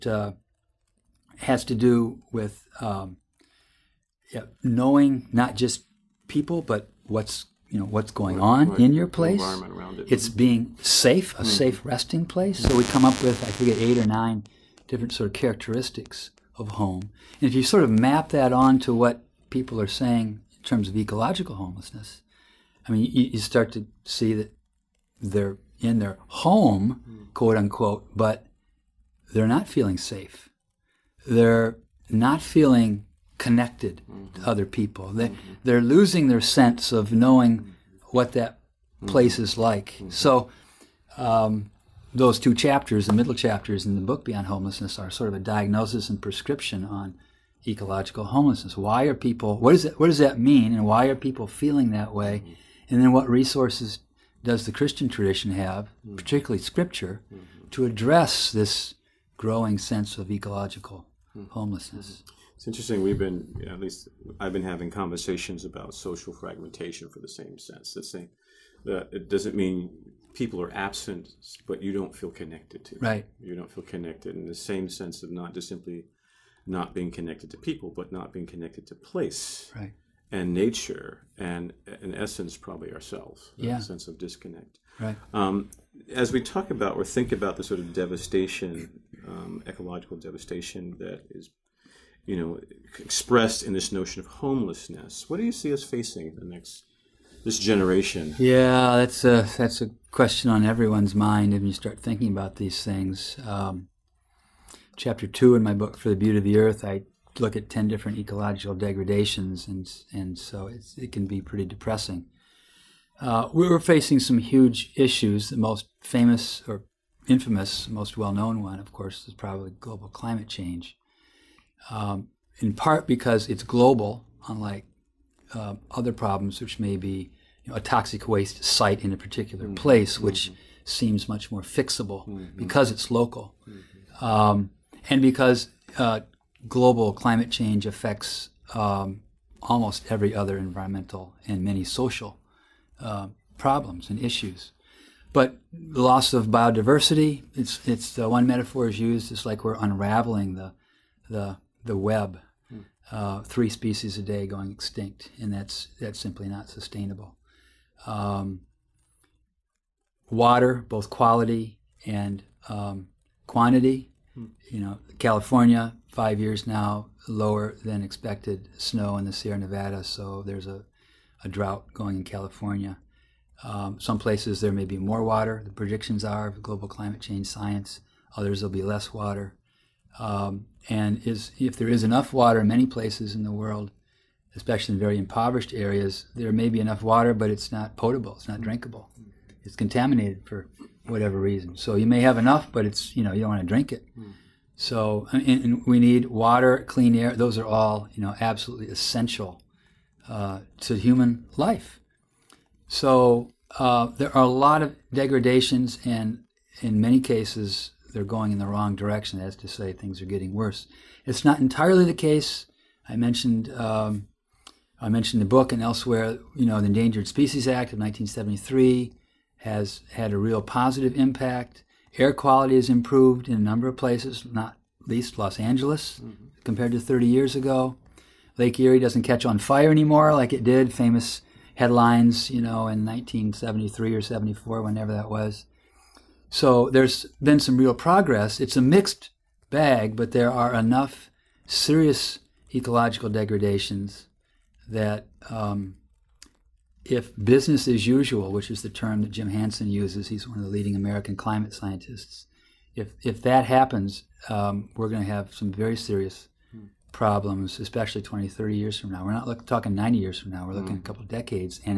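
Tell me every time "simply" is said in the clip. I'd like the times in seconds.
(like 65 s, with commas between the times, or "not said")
75 s, 156 s.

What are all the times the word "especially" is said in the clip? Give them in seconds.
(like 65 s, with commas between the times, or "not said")
184 s, 257 s.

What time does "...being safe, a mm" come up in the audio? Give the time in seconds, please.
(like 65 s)
10 s.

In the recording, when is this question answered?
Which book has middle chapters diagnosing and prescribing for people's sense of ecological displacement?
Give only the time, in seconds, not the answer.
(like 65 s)
44 s.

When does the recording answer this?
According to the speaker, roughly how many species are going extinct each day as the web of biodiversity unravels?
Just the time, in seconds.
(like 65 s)
153 s.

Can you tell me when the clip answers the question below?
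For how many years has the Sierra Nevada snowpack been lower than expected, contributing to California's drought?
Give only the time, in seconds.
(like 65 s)
166 s.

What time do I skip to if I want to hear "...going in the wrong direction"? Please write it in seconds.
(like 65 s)
208 s.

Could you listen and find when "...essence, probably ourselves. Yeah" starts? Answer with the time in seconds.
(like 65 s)
82 s.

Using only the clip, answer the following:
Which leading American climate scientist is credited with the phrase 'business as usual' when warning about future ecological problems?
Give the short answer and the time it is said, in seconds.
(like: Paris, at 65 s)
Jim Hansen, at 249 s.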